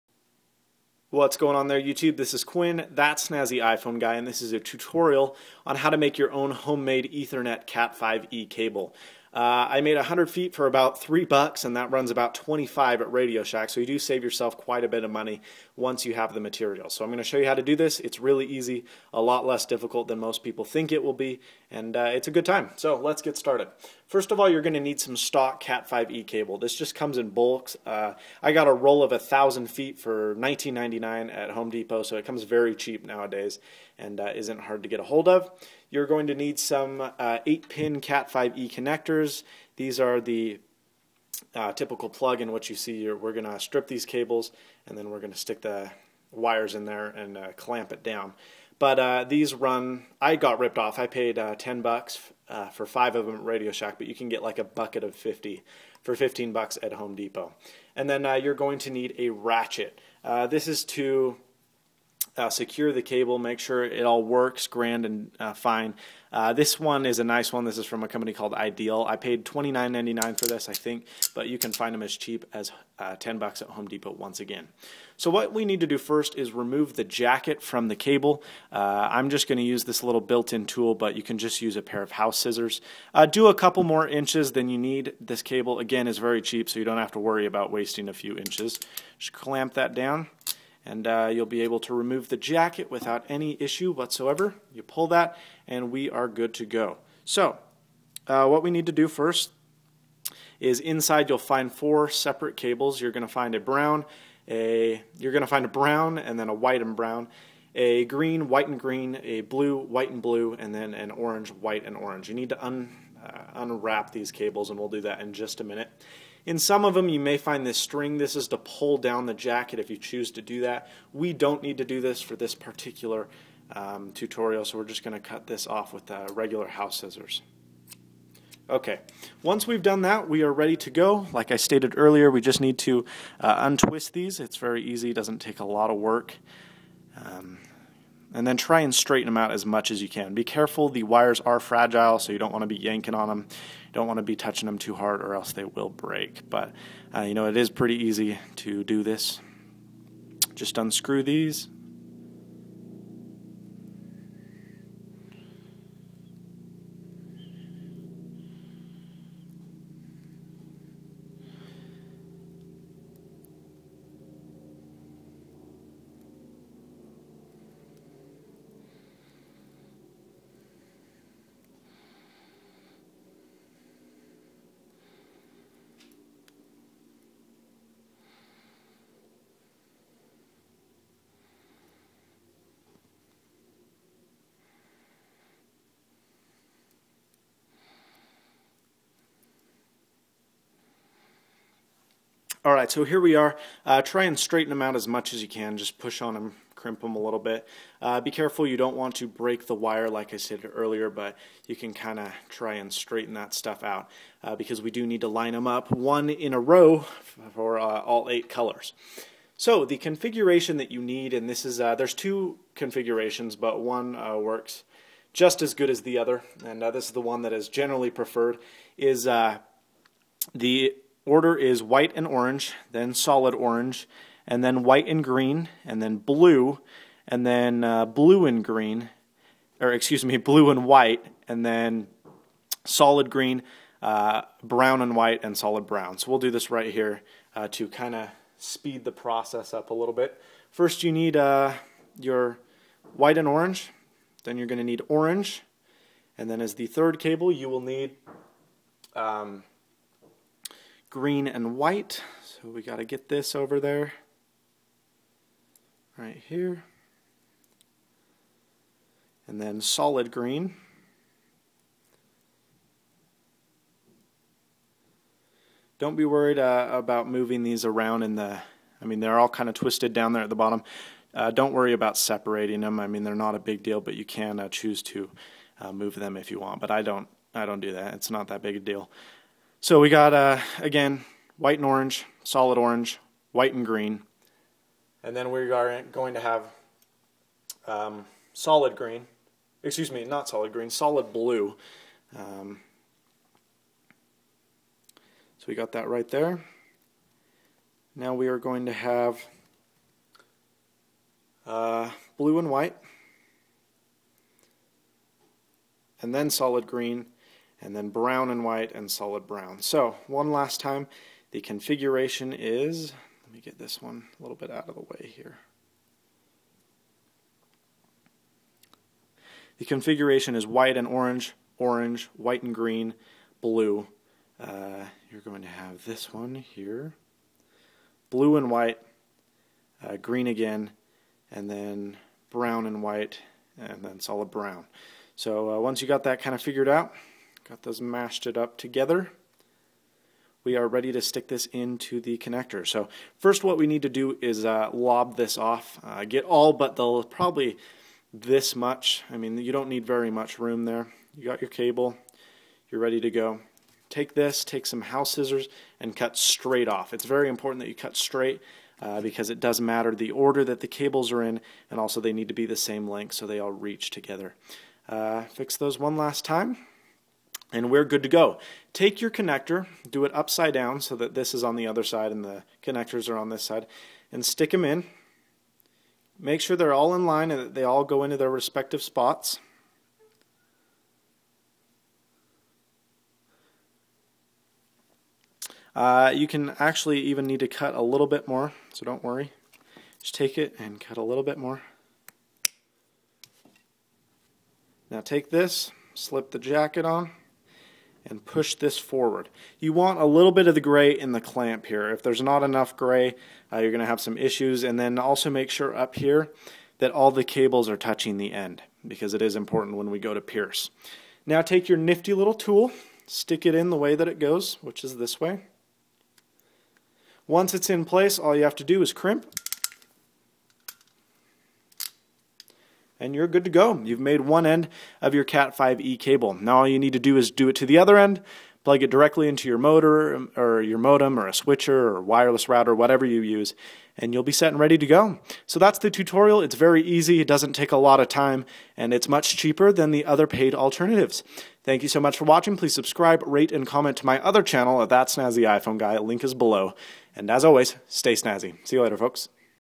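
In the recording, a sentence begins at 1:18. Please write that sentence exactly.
Uh, I'm just going to use this little built-in tool, but you can just use a pair of house scissors.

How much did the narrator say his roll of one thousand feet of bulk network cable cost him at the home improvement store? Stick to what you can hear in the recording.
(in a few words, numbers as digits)
$19.99.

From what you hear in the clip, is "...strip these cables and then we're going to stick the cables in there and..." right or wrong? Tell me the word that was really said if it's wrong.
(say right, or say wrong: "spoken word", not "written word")
wrong: "wires", not "cables".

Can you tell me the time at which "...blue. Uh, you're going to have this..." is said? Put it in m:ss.
5:23.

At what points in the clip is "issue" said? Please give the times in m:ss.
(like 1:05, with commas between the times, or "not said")
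1:33, 6:44.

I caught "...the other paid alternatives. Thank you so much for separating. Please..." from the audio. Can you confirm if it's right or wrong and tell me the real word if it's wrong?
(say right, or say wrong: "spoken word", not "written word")
wrong: "watching", not "separating".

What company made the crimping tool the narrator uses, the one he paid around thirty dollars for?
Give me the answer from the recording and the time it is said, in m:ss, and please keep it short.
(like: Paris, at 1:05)
Ideal, at 1:08.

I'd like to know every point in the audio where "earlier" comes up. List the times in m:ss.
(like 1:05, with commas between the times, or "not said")
2:11, 3:20.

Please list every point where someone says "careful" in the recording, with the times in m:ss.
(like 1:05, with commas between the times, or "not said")
2:20, 3:18.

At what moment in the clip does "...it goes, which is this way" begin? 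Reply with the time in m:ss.
6:54.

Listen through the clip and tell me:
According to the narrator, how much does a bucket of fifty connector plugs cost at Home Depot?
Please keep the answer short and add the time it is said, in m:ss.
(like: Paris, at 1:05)
$15, at 0:56.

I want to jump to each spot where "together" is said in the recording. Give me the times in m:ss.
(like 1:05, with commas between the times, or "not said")
5:38, 6:04.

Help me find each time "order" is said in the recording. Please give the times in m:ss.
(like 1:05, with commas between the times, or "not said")
3:41, 6:00.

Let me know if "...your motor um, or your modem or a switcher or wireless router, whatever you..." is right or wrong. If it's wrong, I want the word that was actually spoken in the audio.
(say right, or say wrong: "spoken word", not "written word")
right.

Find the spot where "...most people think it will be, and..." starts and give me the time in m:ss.
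0:20.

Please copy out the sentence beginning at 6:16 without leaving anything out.
Make sure they're all in line and that they all go into their respective spots.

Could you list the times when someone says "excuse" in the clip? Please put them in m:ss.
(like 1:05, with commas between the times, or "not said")
3:49, 4:49.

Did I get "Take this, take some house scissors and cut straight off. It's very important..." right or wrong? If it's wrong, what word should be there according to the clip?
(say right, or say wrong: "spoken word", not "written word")
right.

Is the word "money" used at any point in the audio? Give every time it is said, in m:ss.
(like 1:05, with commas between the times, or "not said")
0:15.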